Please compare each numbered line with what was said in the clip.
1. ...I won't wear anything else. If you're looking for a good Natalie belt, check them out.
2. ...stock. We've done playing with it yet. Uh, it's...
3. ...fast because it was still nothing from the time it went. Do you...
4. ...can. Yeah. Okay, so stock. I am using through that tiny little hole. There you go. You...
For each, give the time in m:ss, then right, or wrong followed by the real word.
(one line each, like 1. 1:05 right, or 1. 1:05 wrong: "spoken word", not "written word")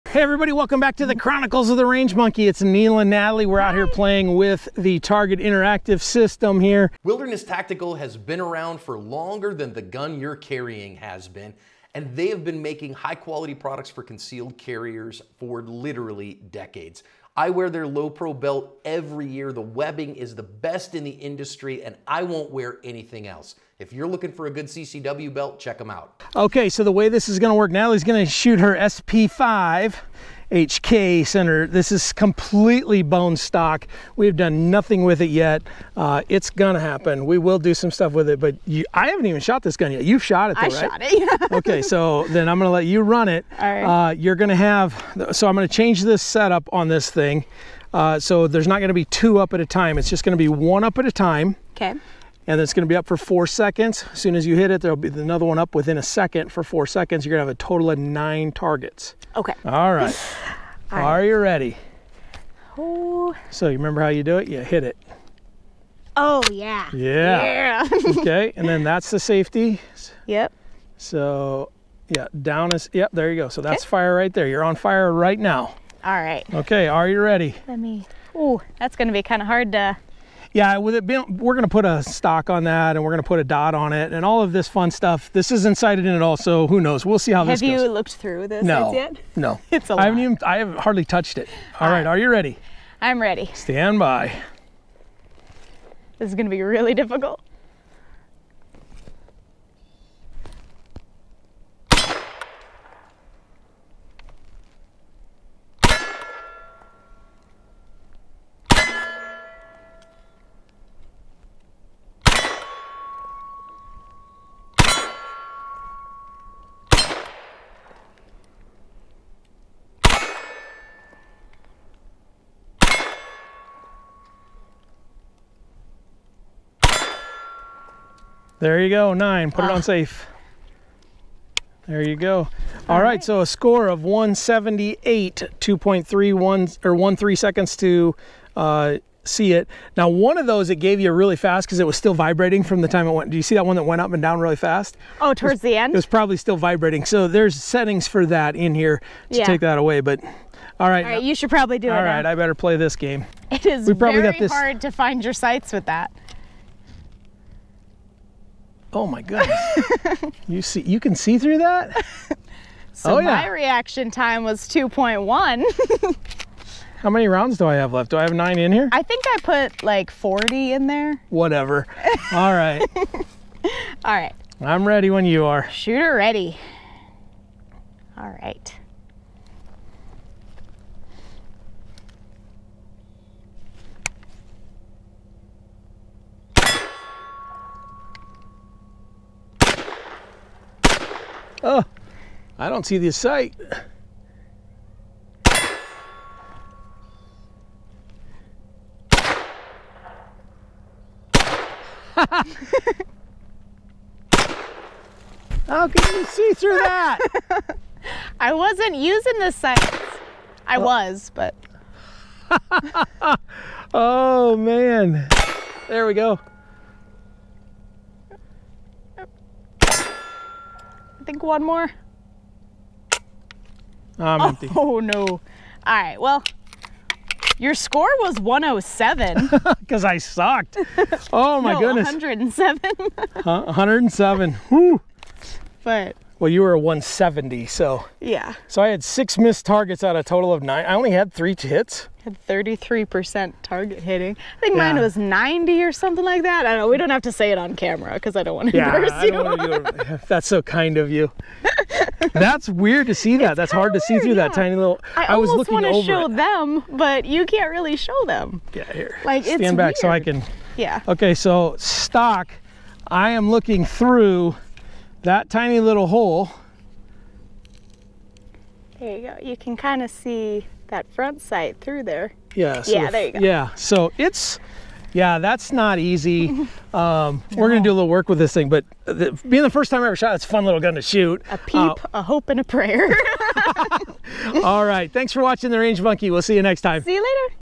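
1. 0:22 wrong: "CCW", not "Natalie"
2. 0:33 wrong: "nothing", not "playing"
3. 2:21 wrong: "vibrating", not "nothing"
4. 4:20 wrong: "looking", not "using".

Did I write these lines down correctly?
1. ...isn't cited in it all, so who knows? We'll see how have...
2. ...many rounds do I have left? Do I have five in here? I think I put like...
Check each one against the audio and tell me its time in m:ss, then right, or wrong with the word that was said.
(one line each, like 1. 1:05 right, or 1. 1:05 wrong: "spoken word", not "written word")
1. 1:25 right
2. 2:47 wrong: "nine", not "five".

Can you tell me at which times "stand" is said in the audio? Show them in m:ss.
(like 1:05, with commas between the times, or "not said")
1:33, 4:19.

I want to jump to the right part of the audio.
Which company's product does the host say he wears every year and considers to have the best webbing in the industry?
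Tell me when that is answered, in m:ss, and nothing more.
0:07.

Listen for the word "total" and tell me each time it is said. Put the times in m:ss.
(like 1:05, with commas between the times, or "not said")
0:57, 4:00.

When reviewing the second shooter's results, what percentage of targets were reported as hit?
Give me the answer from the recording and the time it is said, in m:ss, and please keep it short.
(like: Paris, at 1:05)
33%, at 4:02.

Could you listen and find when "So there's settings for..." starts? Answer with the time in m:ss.
2:27.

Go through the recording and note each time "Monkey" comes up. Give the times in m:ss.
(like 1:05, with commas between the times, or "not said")
0:02, 4:46.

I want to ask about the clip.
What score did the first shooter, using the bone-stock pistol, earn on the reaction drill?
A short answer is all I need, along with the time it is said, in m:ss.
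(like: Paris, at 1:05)
178, at 2:14.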